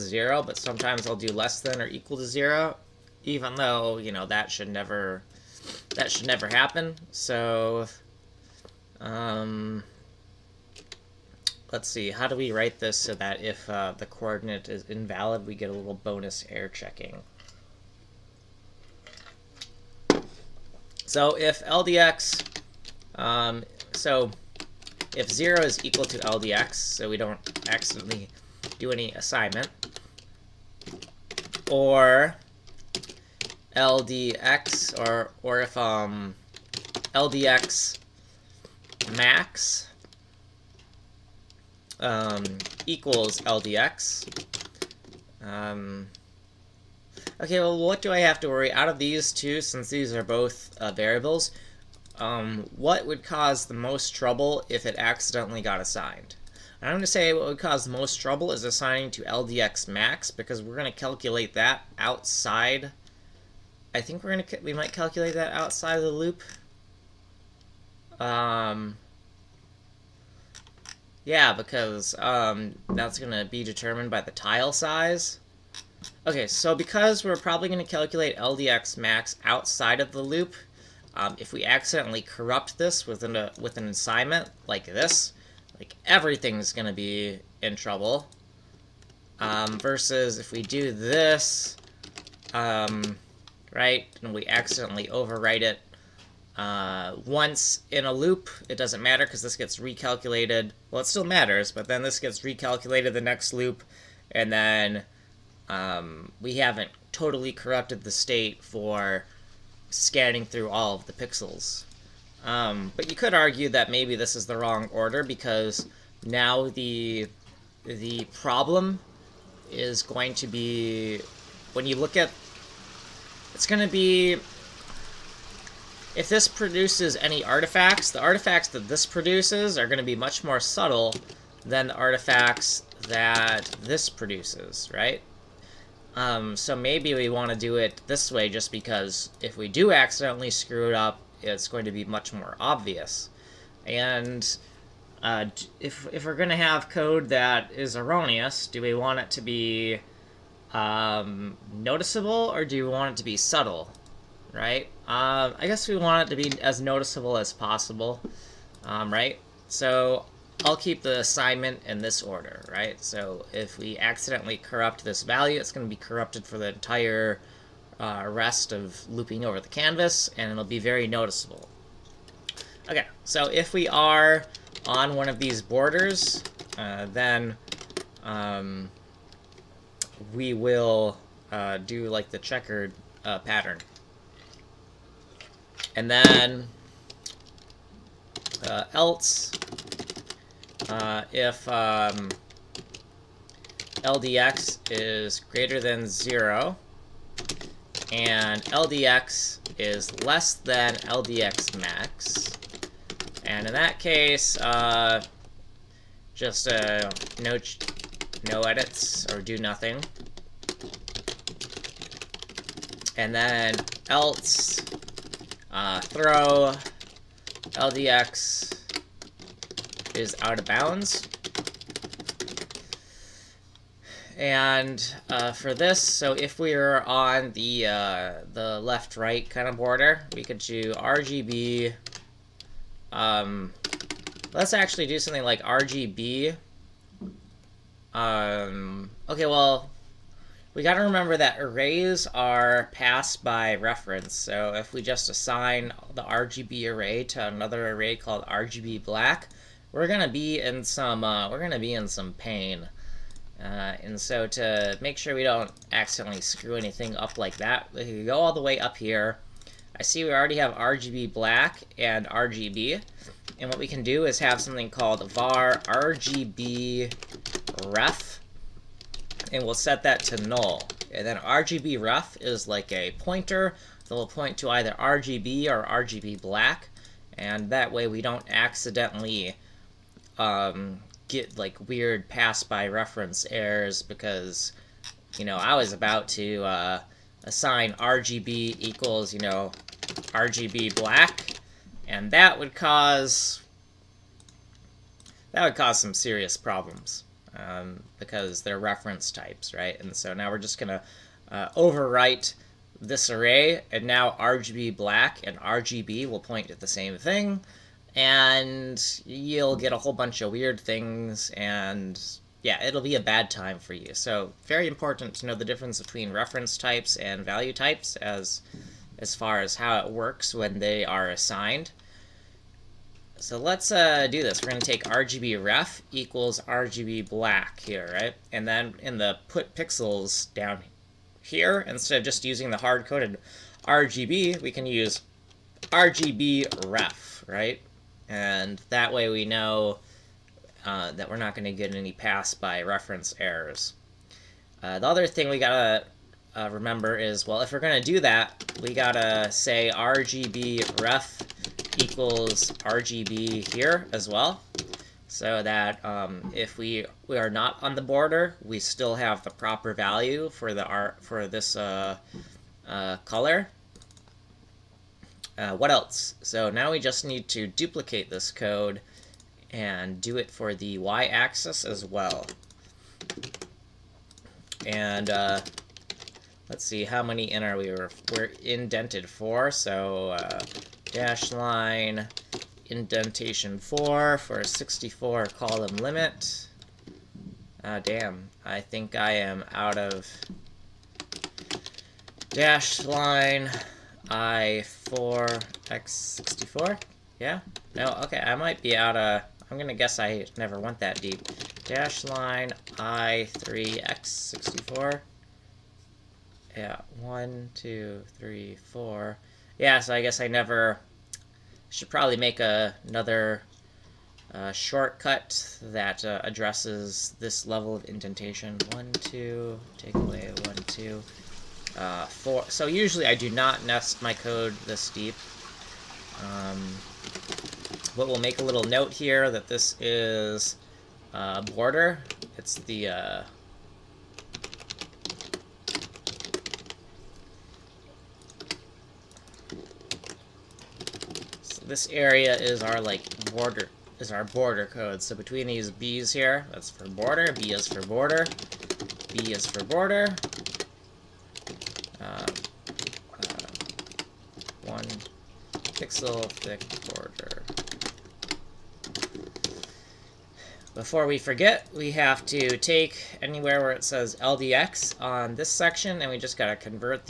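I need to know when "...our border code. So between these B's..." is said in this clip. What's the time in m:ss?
7:24.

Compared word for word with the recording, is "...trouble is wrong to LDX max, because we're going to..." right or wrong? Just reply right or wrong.
wrong.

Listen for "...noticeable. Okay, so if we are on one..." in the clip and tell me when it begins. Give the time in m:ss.
2:51.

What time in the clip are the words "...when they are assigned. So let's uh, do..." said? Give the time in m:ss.
5:20.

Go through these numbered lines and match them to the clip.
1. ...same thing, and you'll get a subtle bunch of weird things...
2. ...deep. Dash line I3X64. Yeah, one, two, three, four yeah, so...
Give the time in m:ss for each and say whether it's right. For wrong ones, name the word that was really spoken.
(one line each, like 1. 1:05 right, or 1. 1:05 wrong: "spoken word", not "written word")
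1. 5:06 wrong: "whole", not "subtle"
2. 6:41 right.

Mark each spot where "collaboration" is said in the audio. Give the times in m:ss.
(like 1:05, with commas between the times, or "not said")
not said.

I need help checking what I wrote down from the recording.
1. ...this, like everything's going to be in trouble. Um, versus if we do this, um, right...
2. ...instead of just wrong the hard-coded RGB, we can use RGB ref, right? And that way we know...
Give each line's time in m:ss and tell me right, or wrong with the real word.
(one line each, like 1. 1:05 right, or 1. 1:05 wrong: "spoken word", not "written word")
1. 1:24 right
2. 5:31 wrong: "using", not "wrong".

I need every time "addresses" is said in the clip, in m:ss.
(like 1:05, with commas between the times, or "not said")
6:56.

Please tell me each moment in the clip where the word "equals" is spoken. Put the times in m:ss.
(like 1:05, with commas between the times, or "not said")
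0:01, 0:25, 0:42, 4:48, 5:26, 5:51.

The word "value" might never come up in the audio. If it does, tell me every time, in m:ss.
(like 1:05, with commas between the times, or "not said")
2:45, 5:17, 5:59.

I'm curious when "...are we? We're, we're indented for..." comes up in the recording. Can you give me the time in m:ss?
6:17.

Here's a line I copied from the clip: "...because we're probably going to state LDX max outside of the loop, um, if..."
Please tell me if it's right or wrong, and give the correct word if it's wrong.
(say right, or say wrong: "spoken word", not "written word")
wrong: "calculate", not "state".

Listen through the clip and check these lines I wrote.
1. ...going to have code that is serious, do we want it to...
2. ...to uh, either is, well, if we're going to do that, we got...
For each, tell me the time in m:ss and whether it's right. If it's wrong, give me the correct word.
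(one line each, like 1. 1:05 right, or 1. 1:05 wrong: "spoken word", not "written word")
1. 2:26 wrong: "erroneous", not "serious"
2. 5:45 wrong: "remember", not "either".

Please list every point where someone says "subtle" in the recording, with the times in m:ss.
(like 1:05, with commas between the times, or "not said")
2:10, 2:33.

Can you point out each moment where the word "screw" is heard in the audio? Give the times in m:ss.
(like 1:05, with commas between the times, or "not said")
2:20, 4:16.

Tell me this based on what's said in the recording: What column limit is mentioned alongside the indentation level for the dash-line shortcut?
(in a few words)
64.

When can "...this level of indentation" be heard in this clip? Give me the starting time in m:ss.
6:57.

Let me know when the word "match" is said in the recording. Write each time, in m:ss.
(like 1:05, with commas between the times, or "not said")
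not said.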